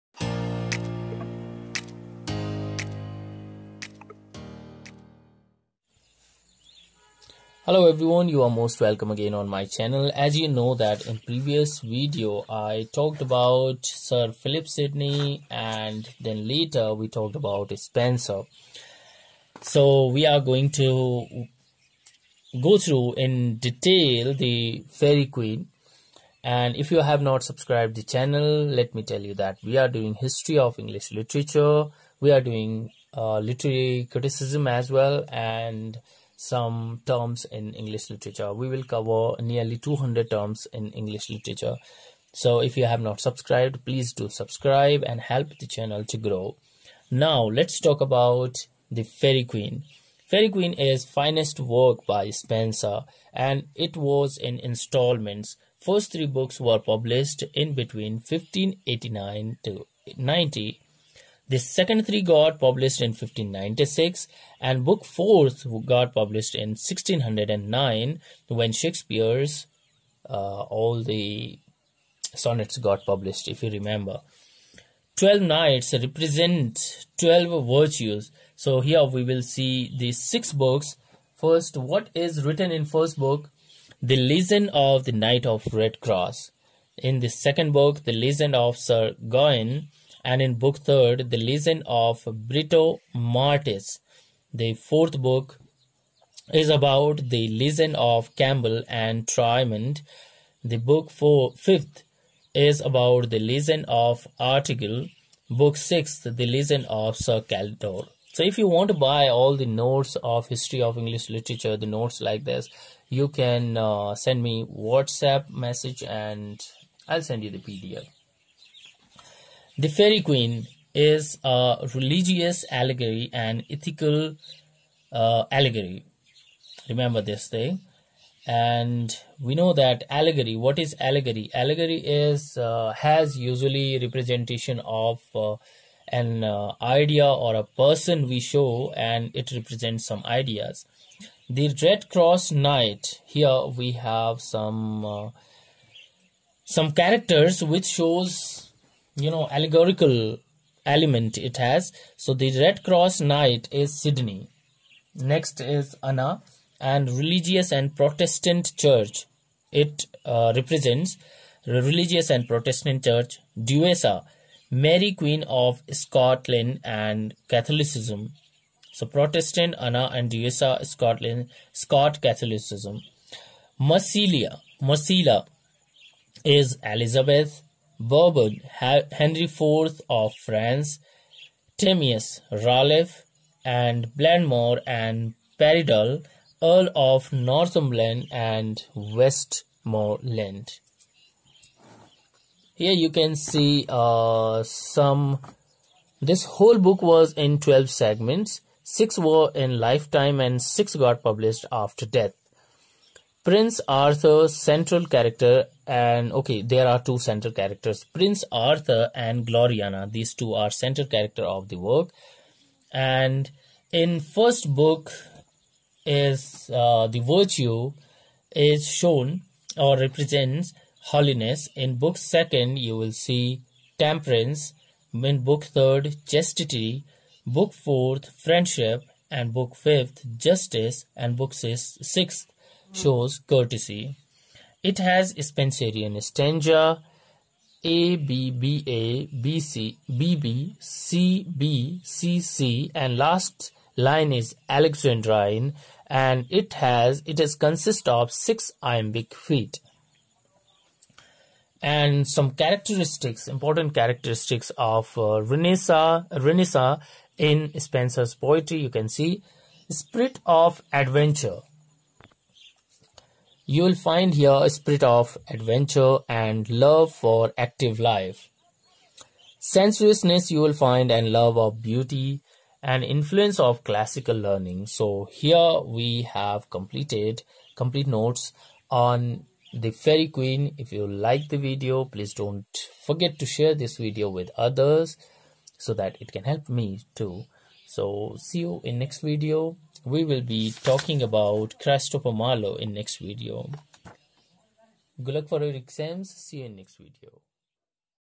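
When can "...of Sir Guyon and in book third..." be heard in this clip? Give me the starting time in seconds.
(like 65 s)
88 s.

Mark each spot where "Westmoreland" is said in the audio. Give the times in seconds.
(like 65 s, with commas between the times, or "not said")
188 s.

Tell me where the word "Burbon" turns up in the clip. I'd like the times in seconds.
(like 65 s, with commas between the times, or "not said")
178 s.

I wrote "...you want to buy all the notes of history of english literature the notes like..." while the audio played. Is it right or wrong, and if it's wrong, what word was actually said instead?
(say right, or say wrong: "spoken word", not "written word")
right.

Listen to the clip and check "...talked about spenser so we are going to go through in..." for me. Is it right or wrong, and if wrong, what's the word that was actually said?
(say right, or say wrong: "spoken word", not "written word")
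right.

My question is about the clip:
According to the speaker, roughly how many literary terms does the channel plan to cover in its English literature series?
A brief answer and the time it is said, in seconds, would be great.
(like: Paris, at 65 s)
200, at 39 s.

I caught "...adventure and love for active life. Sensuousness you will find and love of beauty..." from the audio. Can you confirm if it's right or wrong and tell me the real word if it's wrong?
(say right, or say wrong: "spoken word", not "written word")
right.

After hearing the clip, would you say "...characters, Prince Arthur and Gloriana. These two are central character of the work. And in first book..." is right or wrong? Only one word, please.
right.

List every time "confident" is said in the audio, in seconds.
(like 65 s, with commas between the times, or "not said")
not said.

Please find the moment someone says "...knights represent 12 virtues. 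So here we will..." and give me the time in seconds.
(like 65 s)
75 s.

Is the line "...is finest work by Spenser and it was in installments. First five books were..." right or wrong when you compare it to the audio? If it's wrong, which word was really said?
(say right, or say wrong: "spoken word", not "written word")
wrong: "three", not "five".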